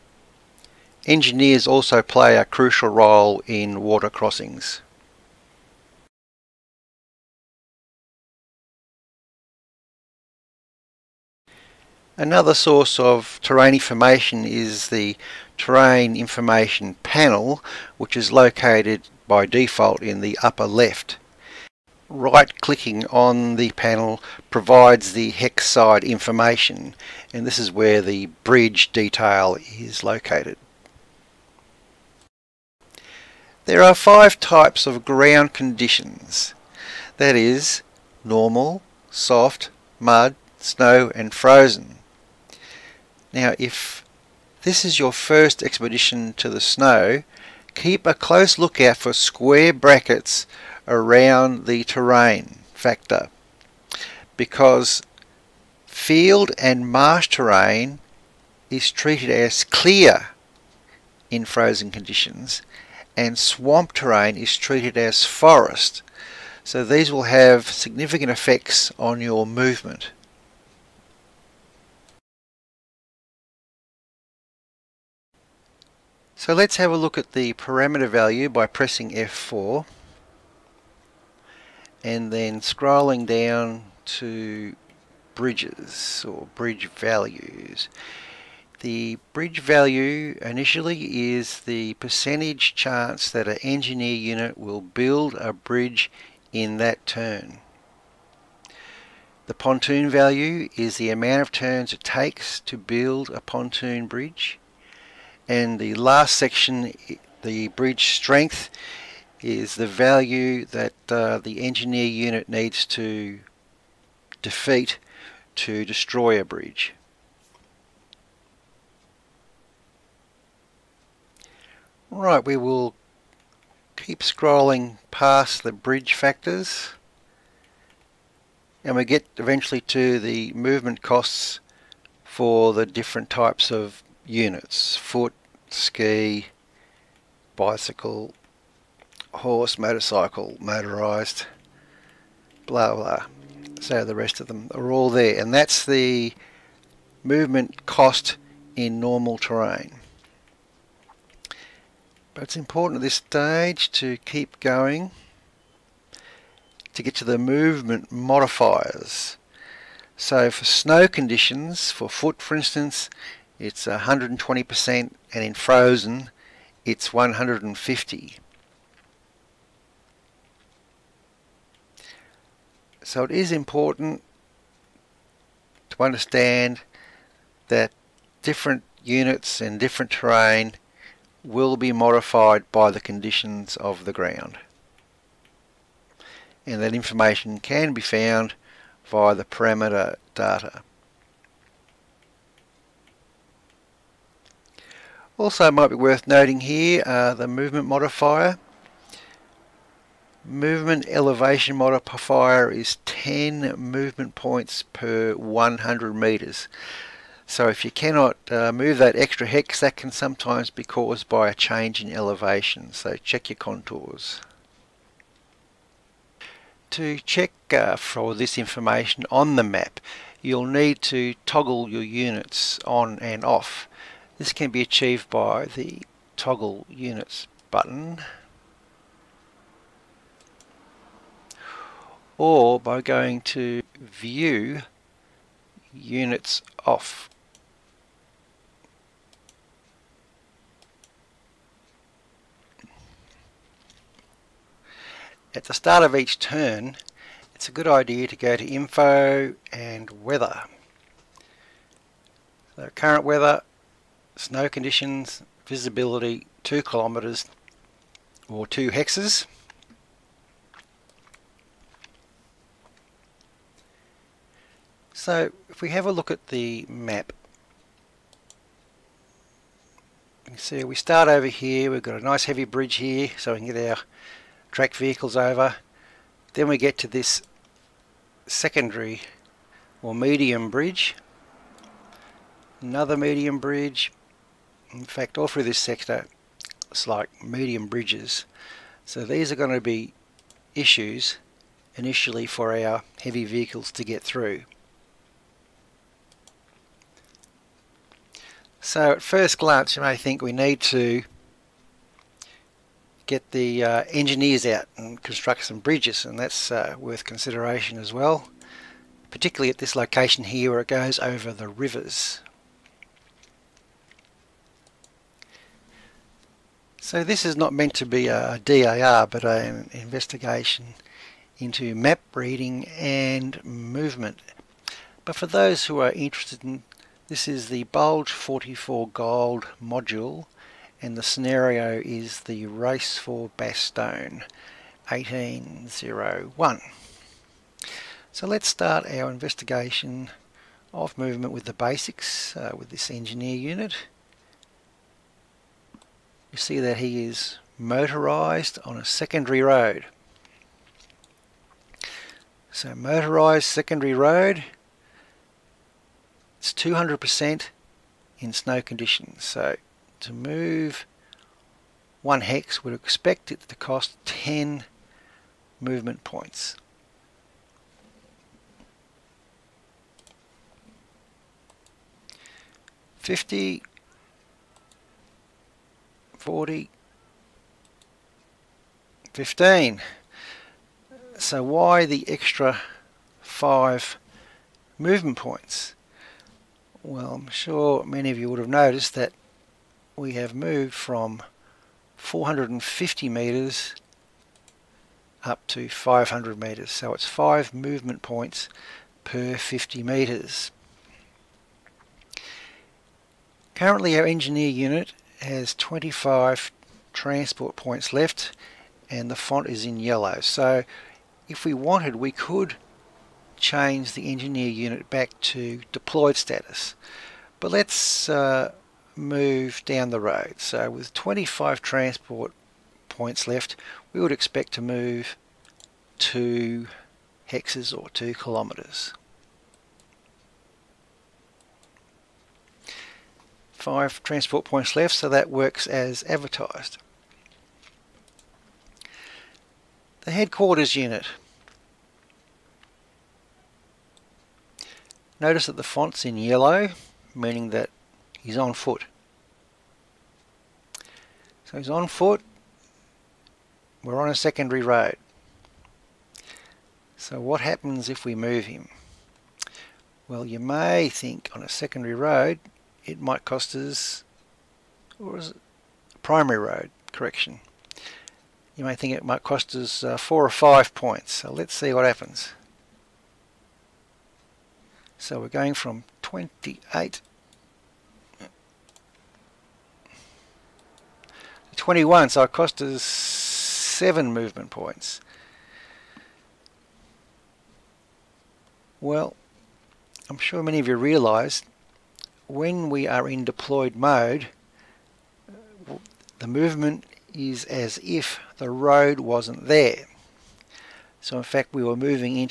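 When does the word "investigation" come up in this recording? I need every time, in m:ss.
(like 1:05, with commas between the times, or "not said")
5:19, 5:39.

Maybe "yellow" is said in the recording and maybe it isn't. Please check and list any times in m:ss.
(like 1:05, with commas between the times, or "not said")
6:49, 7:26.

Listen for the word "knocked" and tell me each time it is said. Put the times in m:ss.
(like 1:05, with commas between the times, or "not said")
not said.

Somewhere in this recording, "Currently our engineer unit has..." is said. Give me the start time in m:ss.
6:43.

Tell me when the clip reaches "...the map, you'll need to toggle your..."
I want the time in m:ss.
3:39.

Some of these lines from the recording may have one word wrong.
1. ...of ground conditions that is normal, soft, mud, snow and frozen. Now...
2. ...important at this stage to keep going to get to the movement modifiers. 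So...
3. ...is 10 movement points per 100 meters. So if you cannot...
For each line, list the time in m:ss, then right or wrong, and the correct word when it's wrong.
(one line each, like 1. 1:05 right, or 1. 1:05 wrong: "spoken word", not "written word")
1. 0:34 right
2. 2:32 right
3. 3:22 right.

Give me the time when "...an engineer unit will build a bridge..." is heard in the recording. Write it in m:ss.
1:33.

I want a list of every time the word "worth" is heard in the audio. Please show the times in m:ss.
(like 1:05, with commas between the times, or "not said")
3:15, 5:06.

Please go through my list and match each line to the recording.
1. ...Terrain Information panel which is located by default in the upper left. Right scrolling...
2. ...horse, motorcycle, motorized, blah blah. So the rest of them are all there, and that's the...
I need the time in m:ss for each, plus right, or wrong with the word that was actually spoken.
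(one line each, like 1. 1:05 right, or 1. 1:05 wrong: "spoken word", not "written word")
1. 0:15 wrong: "clicking", not "scrolling"
2. 2:19 right.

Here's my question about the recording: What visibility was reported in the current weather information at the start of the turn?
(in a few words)
2 kilometers.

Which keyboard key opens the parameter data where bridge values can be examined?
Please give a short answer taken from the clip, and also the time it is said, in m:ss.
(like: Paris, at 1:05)
F4, at 1:19.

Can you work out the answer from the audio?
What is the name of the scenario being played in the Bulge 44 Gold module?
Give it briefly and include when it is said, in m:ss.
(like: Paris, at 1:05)
Race for Bastogne, at 5:32.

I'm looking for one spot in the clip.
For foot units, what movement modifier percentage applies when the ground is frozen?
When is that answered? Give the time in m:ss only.
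2:47.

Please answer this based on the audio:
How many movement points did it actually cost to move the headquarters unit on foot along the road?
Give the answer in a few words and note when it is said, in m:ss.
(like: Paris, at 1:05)
7, at 8:03.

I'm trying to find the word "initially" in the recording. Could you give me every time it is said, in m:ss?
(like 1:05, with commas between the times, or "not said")
1:30, 4:51.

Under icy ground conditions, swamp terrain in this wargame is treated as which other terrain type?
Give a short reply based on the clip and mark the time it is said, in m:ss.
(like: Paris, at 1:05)
forest, at 1:03.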